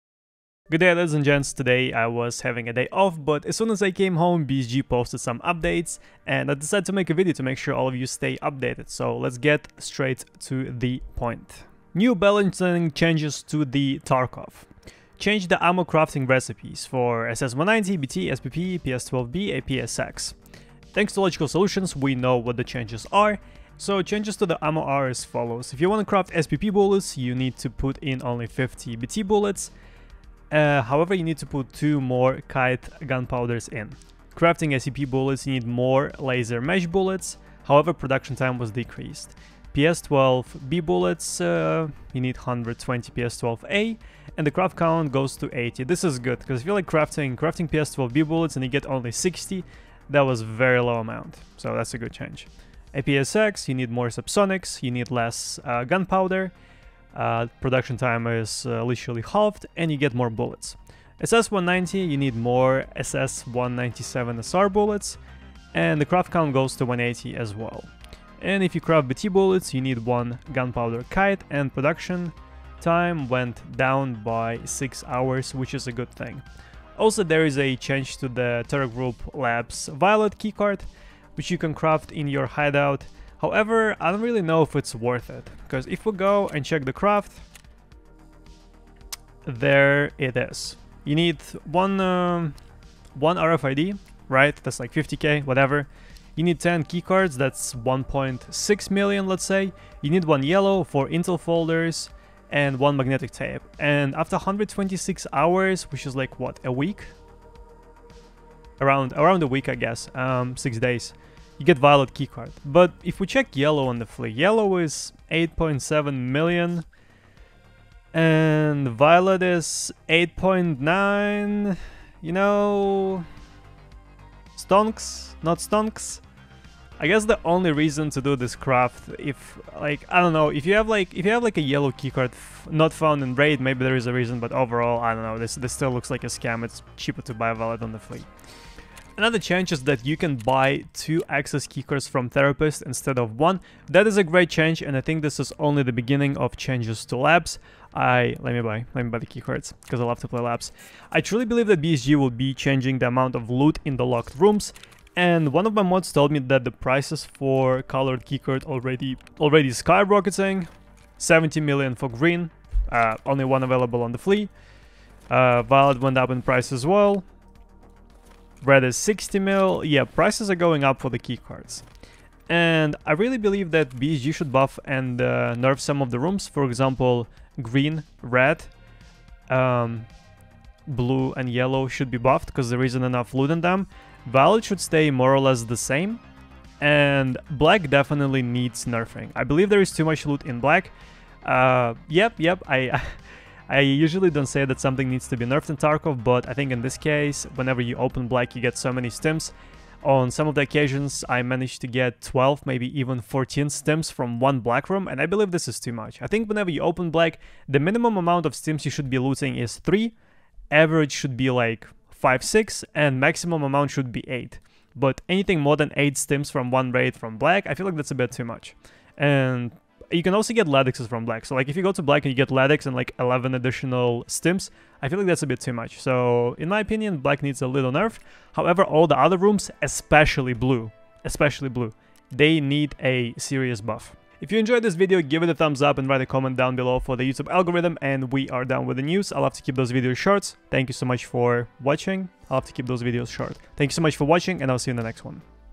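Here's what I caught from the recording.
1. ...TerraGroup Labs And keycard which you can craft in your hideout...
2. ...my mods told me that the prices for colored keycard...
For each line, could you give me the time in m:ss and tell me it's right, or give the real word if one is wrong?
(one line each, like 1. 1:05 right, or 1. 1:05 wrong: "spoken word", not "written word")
1. 1:18 wrong: "Violet", not "And"
2. 2:35 right.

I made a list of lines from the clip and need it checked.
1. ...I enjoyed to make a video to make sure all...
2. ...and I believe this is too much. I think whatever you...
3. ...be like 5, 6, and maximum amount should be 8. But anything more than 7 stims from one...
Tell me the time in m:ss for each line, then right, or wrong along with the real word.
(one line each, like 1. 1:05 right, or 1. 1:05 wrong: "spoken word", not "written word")
1. 0:06 wrong: "decided", not "enjoyed"
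2. 3:25 wrong: "whenever", not "whatever"
3. 3:31 wrong: "8", not "7".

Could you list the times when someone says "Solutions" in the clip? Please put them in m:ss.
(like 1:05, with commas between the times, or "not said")
0:21.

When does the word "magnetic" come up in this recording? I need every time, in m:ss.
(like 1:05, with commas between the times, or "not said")
1:42.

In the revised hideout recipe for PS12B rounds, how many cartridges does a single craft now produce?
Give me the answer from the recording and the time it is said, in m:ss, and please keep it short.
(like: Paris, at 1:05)
80, at 0:45.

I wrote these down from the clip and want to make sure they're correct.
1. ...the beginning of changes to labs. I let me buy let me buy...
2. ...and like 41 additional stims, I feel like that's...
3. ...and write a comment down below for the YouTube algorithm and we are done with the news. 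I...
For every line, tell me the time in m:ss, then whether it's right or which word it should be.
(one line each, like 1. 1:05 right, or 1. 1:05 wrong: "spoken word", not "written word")
1. 2:25 right
2. 3:42 wrong: "11", not "41"
3. 3:55 right.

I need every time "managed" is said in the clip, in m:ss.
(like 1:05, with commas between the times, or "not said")
3:21.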